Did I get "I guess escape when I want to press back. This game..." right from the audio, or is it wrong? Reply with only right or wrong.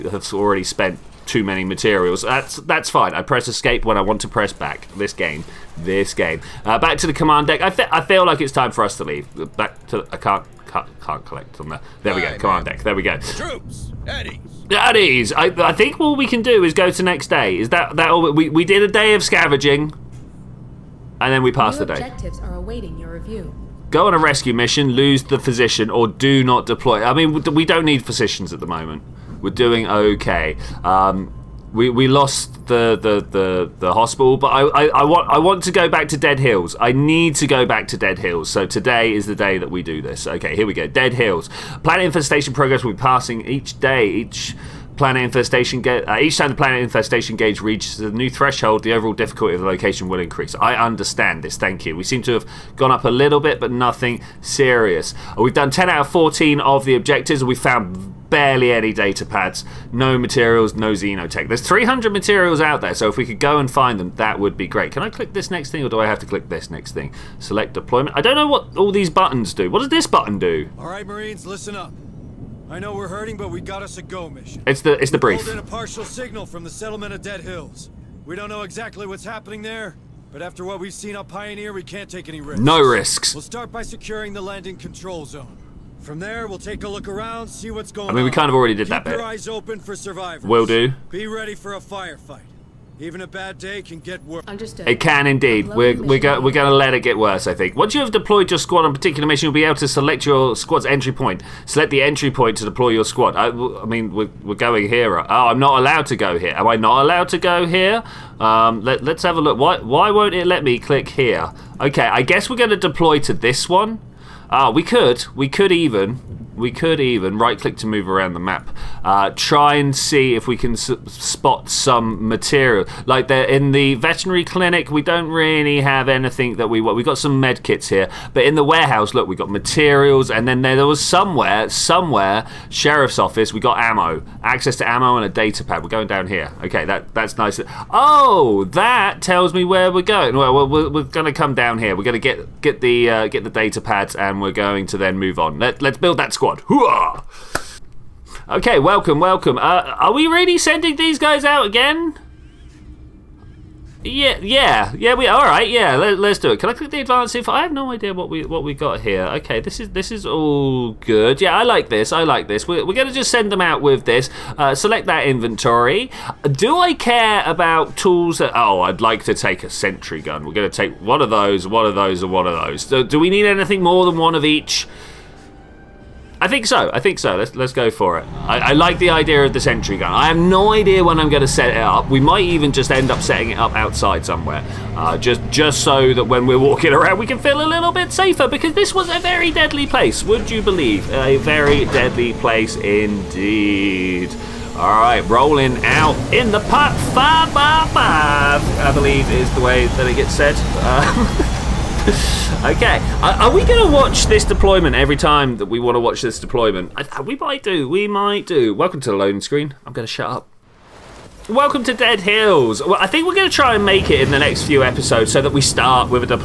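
wrong.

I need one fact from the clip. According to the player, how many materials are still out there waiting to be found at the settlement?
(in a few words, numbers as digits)
300.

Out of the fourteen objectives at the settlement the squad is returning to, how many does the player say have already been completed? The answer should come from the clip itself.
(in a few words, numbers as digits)
10.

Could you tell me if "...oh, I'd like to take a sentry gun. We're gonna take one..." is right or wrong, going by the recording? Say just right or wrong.
right.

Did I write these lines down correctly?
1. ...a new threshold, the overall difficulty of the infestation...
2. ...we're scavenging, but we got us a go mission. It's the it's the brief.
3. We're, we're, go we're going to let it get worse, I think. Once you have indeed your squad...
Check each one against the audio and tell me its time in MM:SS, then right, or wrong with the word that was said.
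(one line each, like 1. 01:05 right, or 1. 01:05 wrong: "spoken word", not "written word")
1. 00:47 wrong: "location", not "infestation"
2. 01:12 wrong: "hurting", not "scavenging"
3. 01:35 wrong: "deployed", not "indeed".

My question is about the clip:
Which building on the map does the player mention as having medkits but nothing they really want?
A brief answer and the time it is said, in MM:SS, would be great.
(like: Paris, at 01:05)
veterinary clinic, at 02:03.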